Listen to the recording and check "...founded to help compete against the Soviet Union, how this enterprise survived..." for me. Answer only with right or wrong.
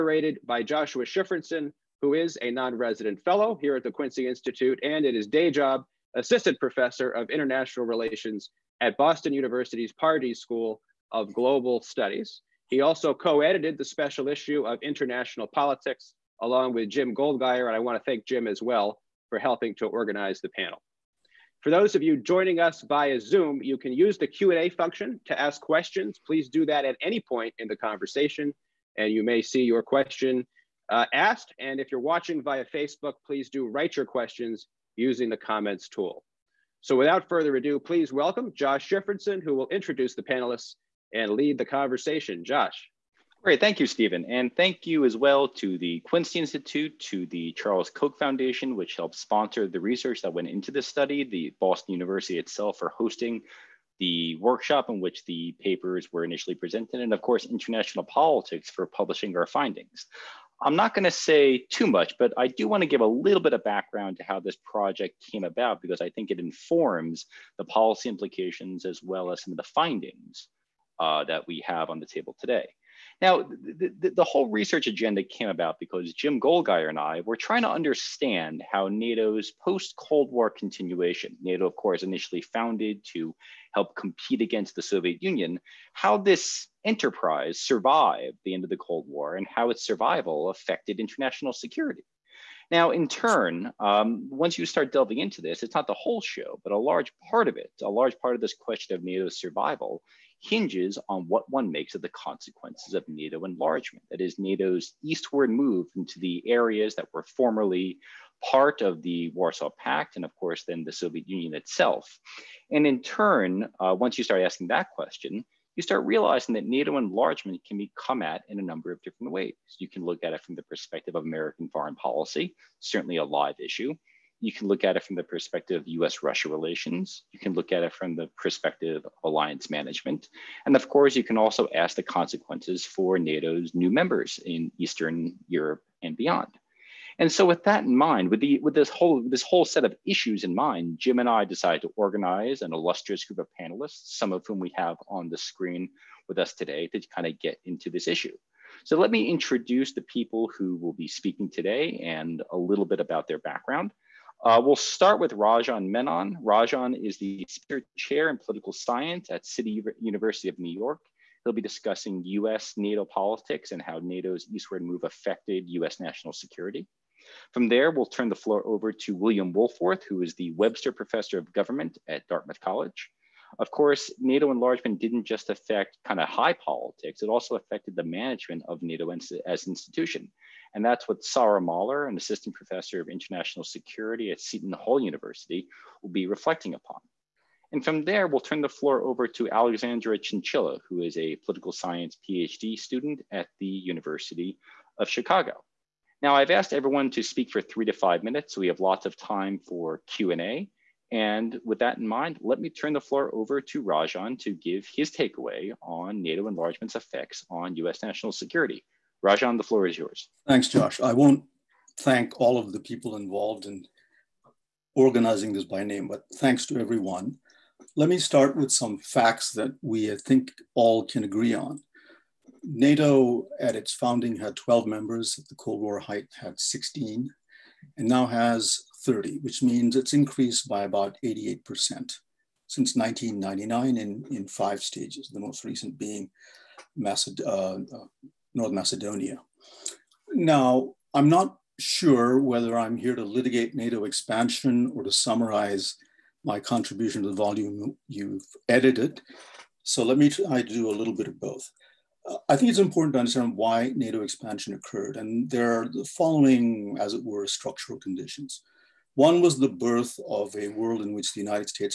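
right.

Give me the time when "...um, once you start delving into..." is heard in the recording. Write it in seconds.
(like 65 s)
93 s.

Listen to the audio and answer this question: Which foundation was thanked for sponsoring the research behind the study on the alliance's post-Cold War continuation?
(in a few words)
Charles Koch Foundation.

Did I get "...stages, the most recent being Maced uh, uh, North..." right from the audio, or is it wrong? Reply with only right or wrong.
right.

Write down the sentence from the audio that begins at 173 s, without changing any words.
Of course, NATO enlargement didn't just affect kind of high politics, it also affected the management of NATO as an institution.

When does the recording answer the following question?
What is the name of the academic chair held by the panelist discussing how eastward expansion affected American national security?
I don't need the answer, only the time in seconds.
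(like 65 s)
157 s.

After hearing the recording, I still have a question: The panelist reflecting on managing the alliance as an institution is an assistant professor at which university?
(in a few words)
Seton Hall University.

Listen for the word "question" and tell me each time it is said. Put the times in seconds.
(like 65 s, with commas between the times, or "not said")
25 s, 29 s, 34 s, 98 s, 114 s.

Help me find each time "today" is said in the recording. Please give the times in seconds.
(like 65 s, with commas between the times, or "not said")
72 s, 146 s, 151 s.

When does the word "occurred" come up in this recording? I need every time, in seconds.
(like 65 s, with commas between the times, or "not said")
254 s.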